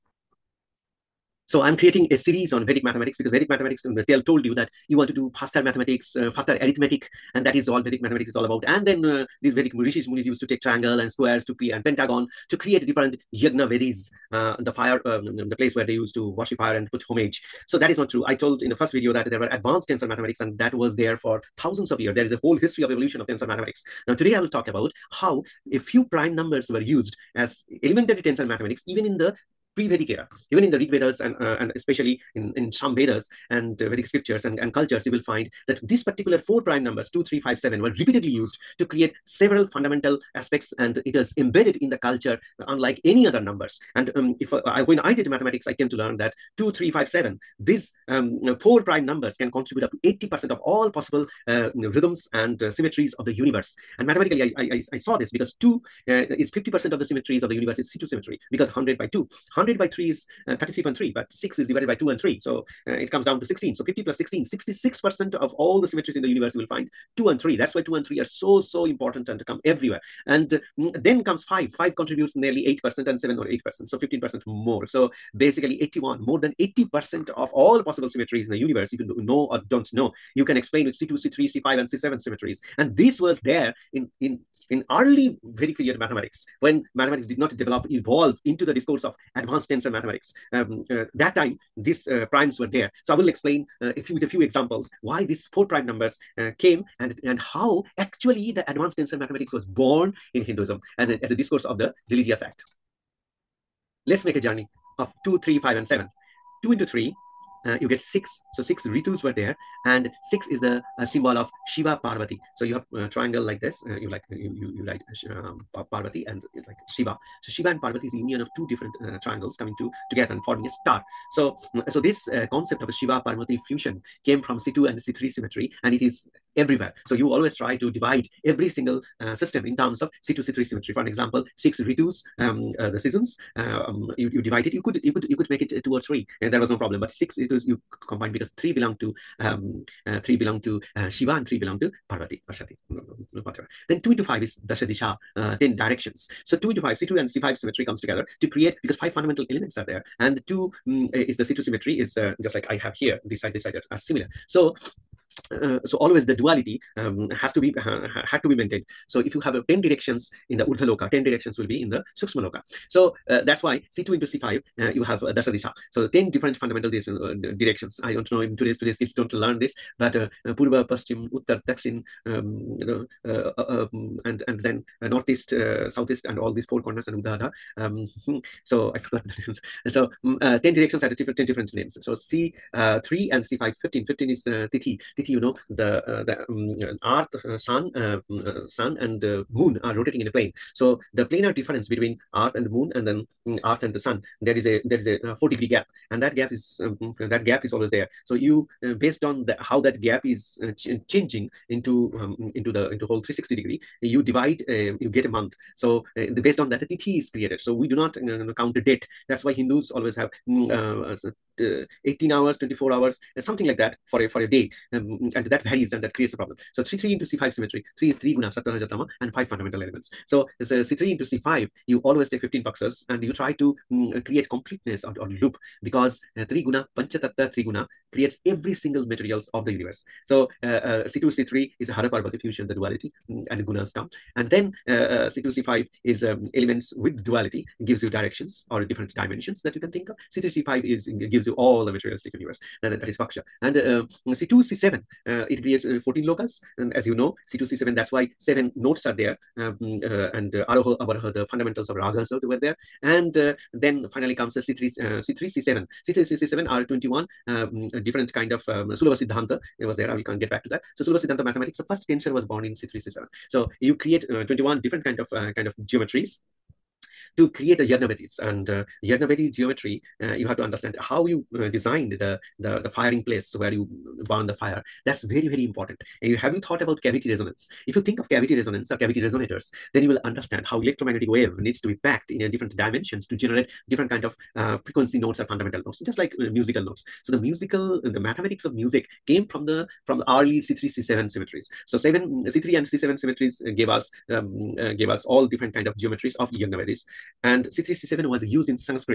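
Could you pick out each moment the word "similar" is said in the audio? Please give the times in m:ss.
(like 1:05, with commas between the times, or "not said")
2:33.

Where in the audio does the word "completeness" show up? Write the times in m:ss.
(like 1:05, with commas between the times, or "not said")
3:44.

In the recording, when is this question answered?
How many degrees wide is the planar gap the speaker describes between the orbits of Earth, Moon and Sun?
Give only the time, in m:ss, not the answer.
3:15.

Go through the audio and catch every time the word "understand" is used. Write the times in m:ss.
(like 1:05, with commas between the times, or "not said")
4:30, 4:40.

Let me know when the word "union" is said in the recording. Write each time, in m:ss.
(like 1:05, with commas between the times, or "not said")
1:58.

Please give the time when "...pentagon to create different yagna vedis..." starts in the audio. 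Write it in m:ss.
0:11.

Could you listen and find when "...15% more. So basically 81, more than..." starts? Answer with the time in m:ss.
1:13.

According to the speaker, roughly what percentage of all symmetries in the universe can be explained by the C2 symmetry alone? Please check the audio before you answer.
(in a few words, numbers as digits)
50%.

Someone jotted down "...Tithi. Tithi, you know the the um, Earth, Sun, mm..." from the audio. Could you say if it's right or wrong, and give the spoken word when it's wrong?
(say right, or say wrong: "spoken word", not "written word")
right.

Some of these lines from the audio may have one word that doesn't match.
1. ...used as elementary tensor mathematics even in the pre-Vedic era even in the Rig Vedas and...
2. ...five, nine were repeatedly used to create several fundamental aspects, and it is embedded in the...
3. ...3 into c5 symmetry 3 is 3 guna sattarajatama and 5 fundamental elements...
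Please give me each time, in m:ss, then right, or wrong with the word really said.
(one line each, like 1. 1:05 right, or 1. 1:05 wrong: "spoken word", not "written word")
1. 0:26 right
2. 0:37 wrong: "seven", not "nine"
3. 3:36 right.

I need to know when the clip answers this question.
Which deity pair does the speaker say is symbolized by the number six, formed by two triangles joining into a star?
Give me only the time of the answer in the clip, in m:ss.
1:57.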